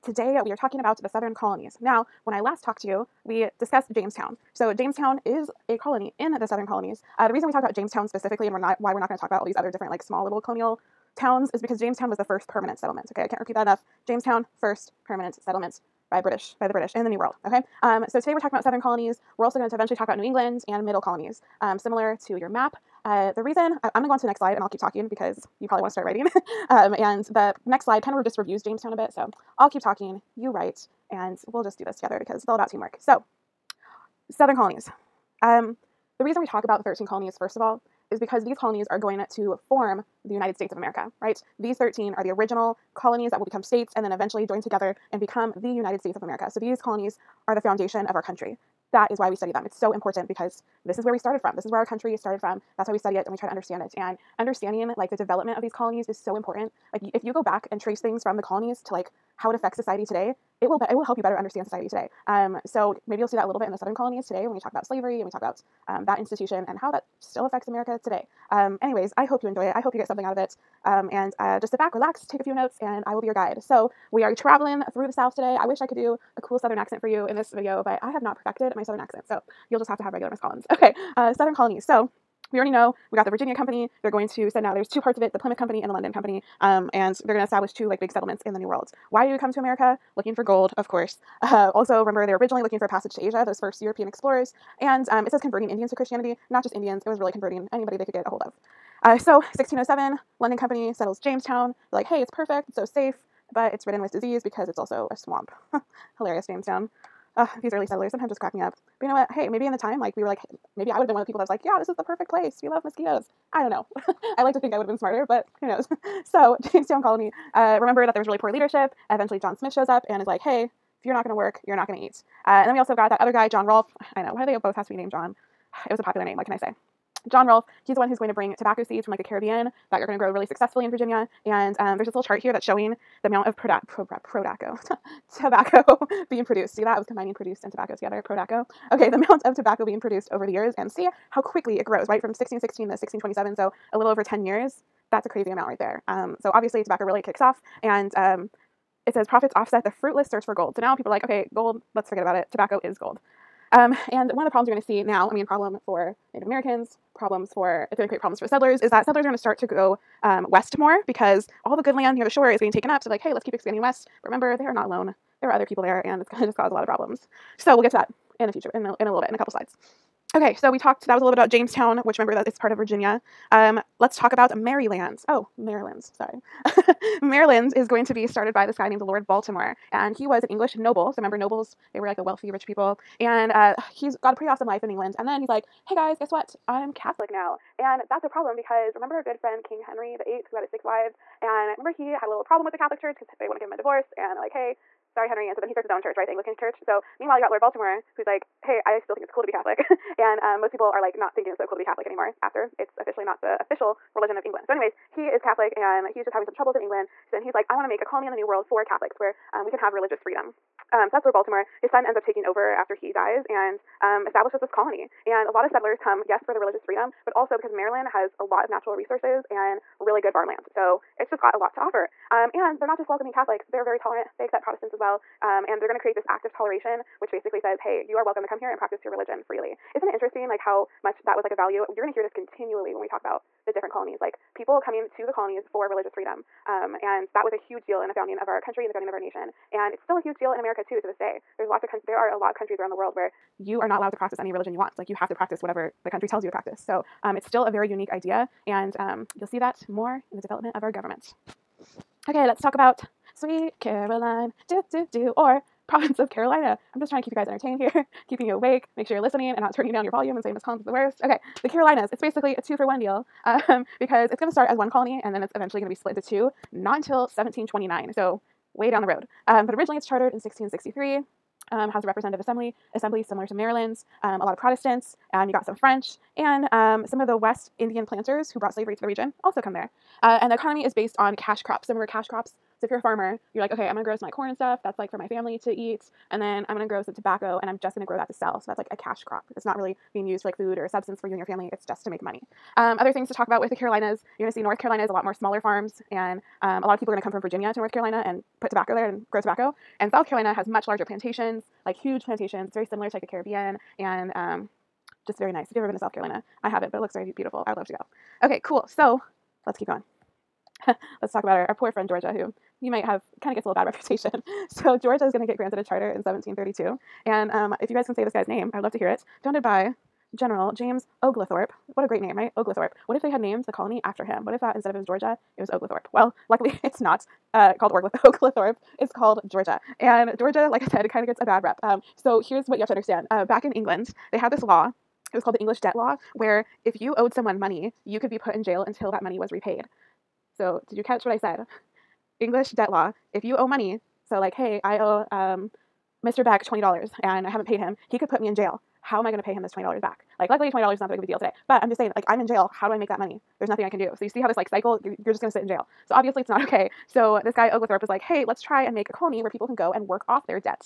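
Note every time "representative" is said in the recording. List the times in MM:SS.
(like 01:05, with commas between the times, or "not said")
04:32.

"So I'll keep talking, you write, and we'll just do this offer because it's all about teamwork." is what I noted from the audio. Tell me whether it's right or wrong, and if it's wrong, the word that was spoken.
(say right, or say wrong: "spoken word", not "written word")
wrong: "together", not "offer".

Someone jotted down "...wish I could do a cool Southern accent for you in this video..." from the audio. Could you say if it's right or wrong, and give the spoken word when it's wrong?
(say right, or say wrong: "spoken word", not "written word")
right.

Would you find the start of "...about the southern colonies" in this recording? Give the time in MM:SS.
00:00.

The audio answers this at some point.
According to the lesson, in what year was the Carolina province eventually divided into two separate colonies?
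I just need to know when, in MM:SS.
04:27.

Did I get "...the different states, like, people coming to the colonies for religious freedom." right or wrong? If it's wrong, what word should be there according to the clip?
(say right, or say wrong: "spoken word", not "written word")
wrong: "colonies", not "states".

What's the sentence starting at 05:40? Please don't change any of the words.
So, did you catch what I said?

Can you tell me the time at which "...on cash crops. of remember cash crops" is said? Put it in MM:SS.
04:41.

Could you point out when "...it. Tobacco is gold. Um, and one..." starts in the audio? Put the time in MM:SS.
02:32.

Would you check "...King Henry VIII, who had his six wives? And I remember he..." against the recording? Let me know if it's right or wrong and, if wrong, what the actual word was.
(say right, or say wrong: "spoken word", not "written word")
right.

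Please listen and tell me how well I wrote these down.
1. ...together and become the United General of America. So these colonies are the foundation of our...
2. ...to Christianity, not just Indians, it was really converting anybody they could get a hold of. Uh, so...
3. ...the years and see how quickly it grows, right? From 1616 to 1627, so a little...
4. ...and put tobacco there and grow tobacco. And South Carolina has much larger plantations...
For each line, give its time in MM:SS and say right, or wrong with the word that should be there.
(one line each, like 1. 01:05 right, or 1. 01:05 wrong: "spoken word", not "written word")
1. 00:44 wrong: "States", not "General"
2. 01:35 right
3. 02:20 right
4. 04:58 right.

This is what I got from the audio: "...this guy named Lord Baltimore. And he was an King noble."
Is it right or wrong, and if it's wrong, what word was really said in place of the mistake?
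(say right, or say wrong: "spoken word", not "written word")
wrong: "English", not "King".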